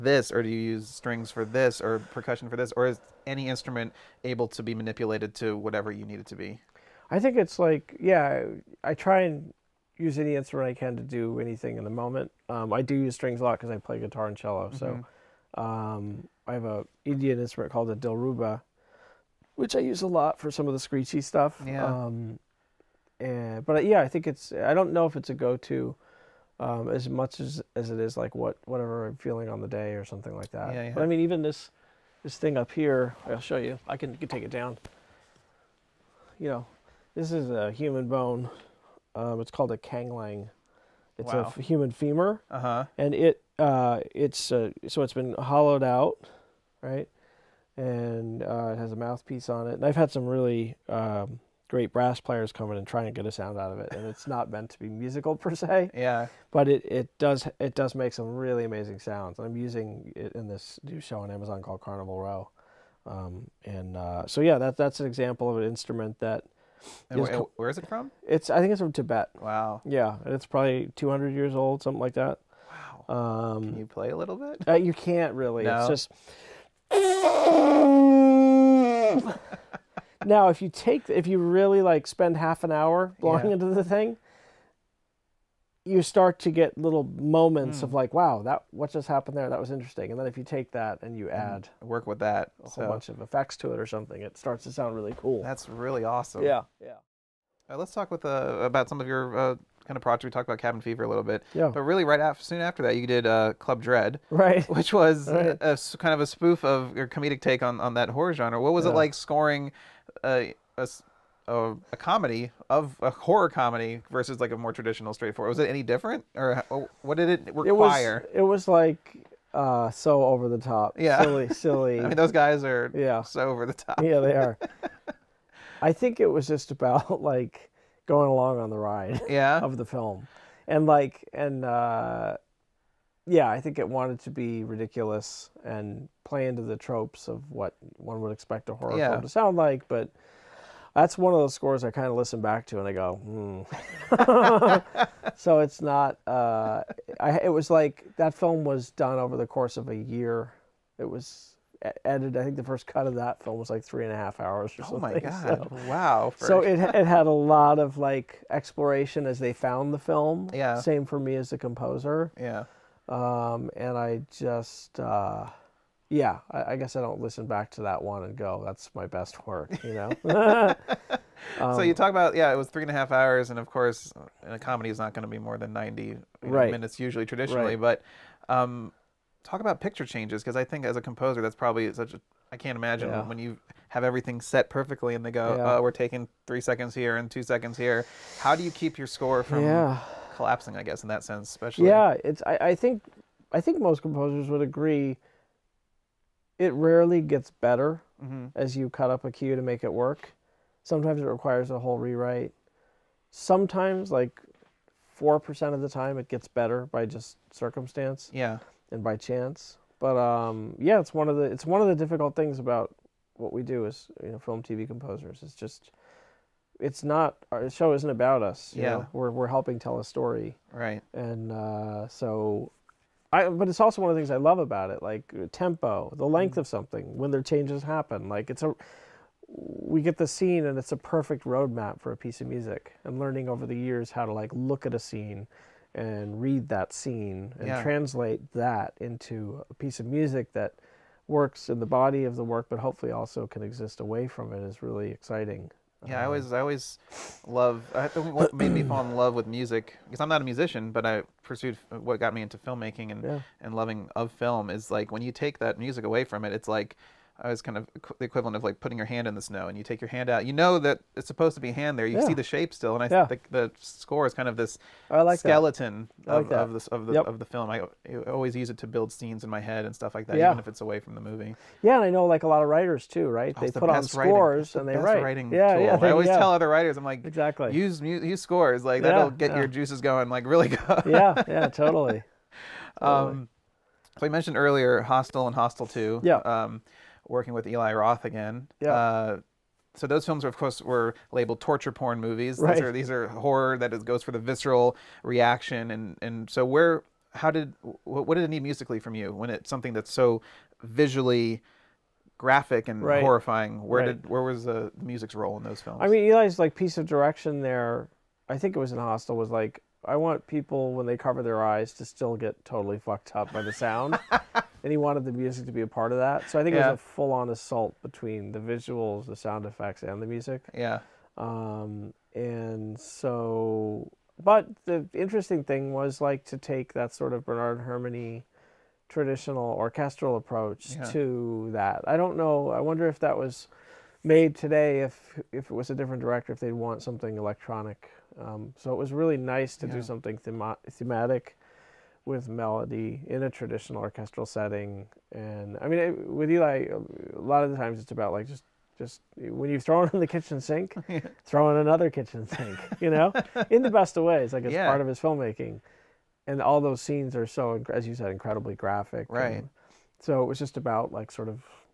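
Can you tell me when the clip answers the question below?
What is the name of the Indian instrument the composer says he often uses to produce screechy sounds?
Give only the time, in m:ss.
0:17.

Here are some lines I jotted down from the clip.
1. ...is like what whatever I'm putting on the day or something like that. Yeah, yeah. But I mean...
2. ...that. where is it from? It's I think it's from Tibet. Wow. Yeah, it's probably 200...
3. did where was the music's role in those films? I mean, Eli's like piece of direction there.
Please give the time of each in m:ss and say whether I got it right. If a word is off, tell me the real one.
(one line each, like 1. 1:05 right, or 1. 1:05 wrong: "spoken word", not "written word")
1. 0:27 wrong: "feeling", not "putting"
2. 1:06 right
3. 5:04 right.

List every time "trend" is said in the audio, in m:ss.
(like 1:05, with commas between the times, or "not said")
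not said.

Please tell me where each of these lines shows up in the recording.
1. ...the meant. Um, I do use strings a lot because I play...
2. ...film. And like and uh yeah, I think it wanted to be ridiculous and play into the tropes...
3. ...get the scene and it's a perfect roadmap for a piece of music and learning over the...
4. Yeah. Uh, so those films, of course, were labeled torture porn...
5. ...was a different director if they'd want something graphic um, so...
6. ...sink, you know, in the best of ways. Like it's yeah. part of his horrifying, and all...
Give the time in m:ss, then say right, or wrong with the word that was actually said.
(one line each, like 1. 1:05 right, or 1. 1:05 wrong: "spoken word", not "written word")
1. 0:11 wrong: "moment", not "meant"
2. 2:09 right
3. 3:50 right
4. 4:48 right
5. 5:35 wrong: "electronic", not "graphic"
6. 5:52 wrong: "filmmaking", not "horrifying".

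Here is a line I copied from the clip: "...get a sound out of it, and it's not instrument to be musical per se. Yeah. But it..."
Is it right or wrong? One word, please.
wrong.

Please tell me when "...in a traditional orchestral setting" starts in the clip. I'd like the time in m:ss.
5:43.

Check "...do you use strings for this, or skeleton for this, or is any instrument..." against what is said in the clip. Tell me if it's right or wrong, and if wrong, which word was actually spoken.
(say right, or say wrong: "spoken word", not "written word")
wrong: "percussion", not "skeleton".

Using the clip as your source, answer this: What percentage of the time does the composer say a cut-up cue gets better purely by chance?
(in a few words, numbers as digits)
4 percent.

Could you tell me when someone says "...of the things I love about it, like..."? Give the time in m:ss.
3:44.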